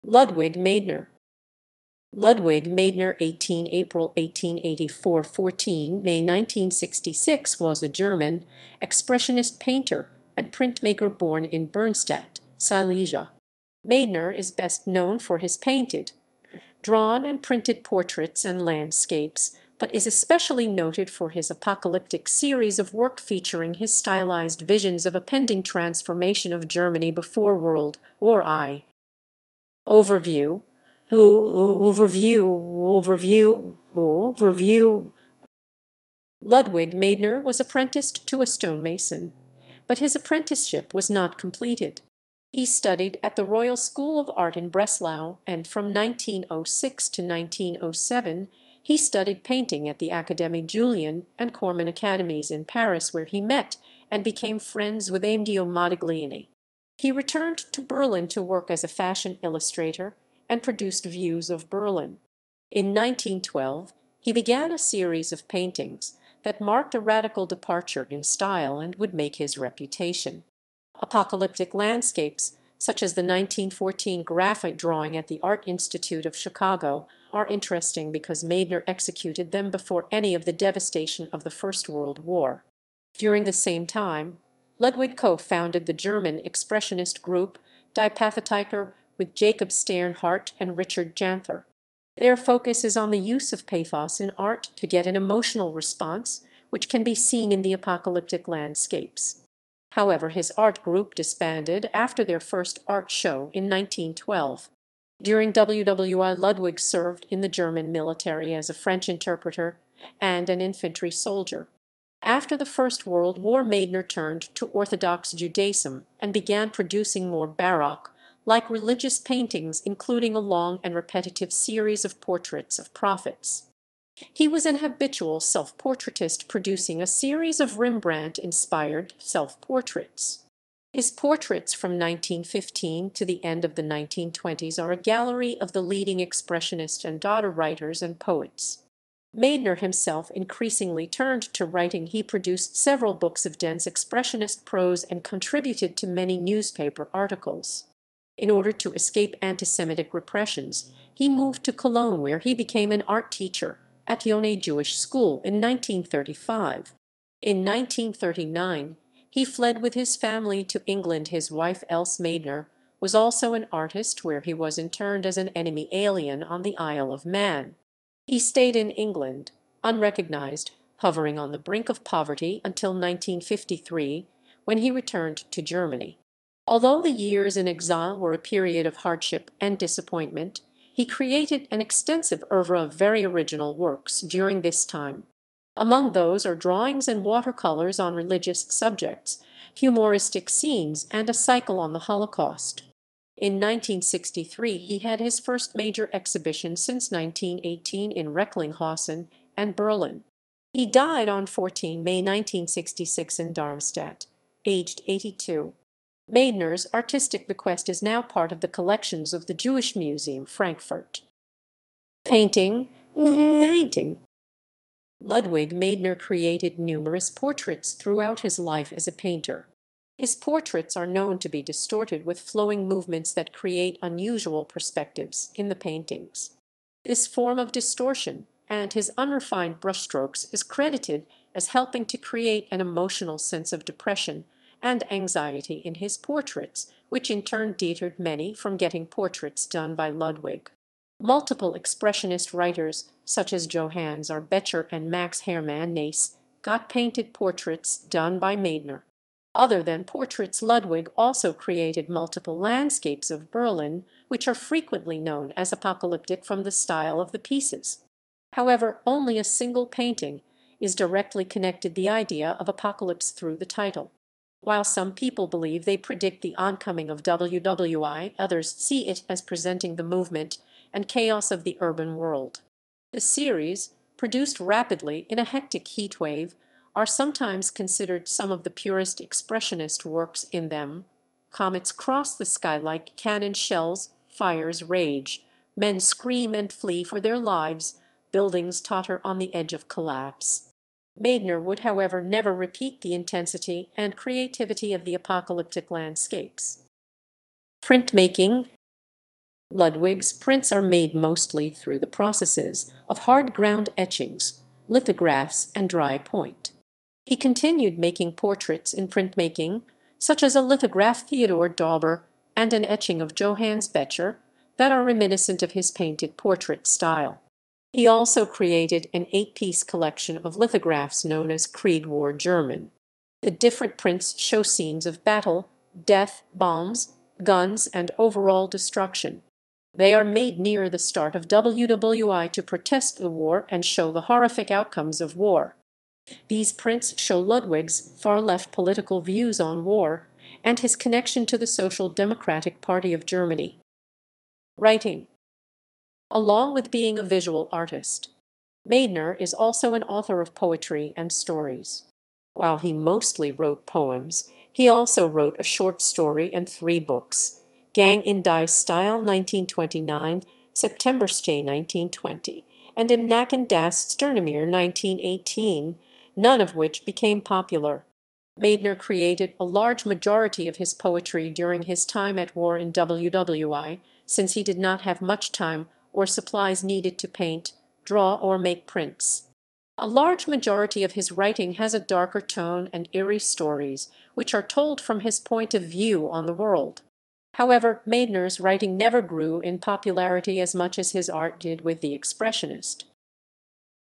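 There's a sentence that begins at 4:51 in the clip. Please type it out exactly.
Meidner would, however, never repeat the intensity and creativity of the apocalyptic landscapes.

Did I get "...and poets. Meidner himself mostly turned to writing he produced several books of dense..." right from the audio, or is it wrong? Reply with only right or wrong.
wrong.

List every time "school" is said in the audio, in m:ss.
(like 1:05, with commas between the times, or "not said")
0:43, 2:34.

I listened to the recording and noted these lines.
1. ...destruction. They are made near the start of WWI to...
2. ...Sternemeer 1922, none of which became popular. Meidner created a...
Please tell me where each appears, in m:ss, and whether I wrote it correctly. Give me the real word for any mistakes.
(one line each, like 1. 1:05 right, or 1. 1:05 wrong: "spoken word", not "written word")
1. 5:28 right
2. 6:04 wrong: "1918", not "1922".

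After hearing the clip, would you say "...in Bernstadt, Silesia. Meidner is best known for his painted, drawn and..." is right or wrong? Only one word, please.
right.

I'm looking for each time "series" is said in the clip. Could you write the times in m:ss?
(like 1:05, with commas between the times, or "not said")
0:22, 1:04, 2:01, 2:07, 4:33.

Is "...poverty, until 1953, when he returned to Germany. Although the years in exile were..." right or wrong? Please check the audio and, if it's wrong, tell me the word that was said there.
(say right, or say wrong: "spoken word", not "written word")
right.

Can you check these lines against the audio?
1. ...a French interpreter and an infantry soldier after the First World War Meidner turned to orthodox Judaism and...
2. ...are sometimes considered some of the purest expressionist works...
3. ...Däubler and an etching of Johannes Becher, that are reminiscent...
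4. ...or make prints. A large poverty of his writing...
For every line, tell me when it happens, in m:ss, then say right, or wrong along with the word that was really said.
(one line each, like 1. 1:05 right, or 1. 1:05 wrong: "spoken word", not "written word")
1. 1:48 right
2. 4:36 right
3. 5:11 right
4. 6:18 wrong: "majority", not "poverty".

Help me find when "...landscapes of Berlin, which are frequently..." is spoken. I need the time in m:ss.
4:12.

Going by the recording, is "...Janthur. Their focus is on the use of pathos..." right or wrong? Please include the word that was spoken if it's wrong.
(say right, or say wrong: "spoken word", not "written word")
right.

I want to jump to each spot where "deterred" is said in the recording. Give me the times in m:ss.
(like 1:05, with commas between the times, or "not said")
3:57.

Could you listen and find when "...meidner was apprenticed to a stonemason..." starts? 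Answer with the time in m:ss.
0:36.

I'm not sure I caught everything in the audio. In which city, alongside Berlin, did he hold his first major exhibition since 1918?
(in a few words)
Recklinghausen.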